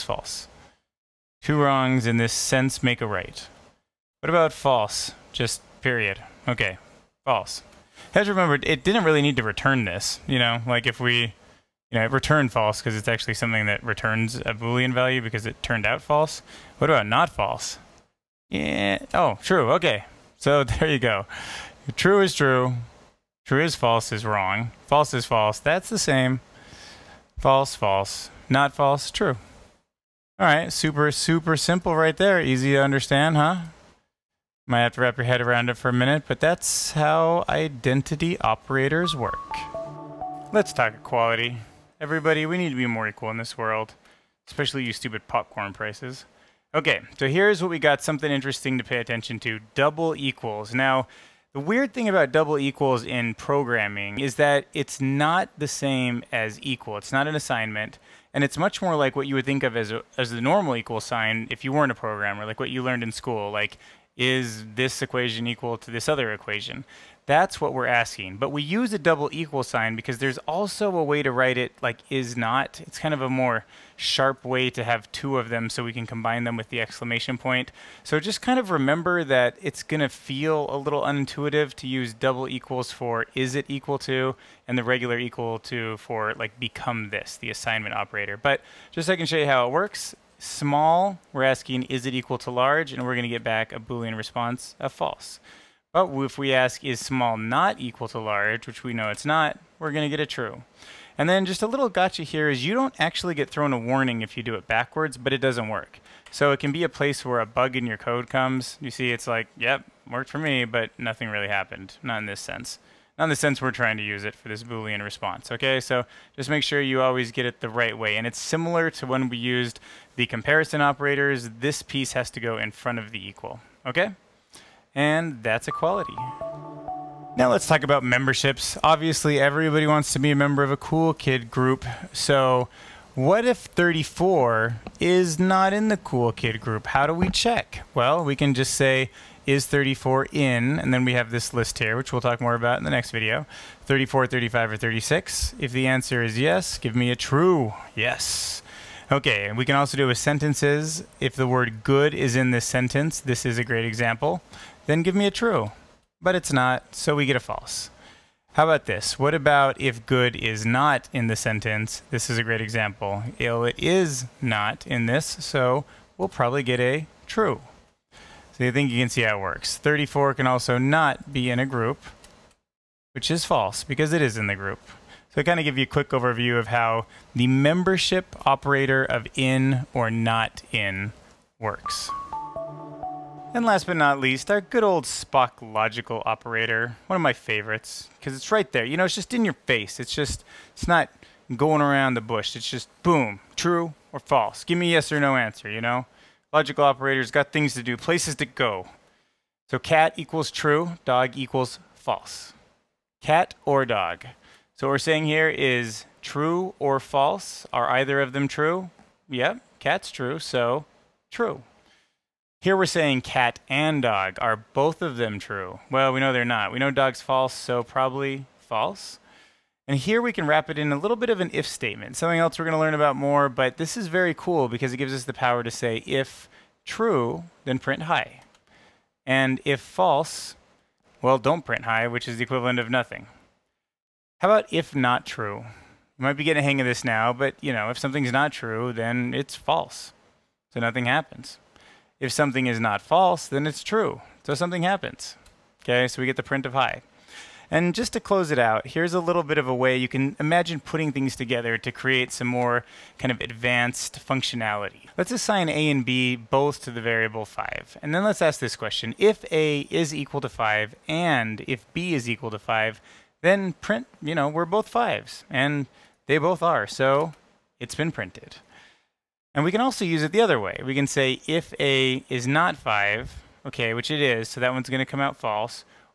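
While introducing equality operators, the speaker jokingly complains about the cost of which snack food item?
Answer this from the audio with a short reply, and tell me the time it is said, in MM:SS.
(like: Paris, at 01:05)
Popcorn, at 00:45.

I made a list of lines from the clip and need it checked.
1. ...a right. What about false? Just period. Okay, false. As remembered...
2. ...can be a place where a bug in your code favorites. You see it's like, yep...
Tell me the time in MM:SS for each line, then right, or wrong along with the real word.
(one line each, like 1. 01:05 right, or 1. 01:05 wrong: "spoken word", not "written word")
1. 00:03 right
2. 01:46 wrong: "comes", not "favorites".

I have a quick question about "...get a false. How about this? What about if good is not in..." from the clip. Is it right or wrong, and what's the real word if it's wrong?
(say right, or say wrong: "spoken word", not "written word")
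right.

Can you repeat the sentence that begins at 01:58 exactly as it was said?
And it's similar to when we used the comparison operators.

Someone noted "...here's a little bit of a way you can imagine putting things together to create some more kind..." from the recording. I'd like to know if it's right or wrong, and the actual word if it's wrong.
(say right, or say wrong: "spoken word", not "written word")
right.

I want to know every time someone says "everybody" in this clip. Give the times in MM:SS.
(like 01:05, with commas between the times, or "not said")
00:41, 02:09.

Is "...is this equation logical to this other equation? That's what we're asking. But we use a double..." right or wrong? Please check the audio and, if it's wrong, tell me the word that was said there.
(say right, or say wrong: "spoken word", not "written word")
wrong: "equal", not "logical".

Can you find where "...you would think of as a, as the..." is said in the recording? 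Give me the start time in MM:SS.
00:59.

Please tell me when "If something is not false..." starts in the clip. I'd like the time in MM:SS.
04:02.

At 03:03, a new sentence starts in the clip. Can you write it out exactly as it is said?
And last but not least, our good old Spock logical operator.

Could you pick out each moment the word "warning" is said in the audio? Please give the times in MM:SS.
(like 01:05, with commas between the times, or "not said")
01:43.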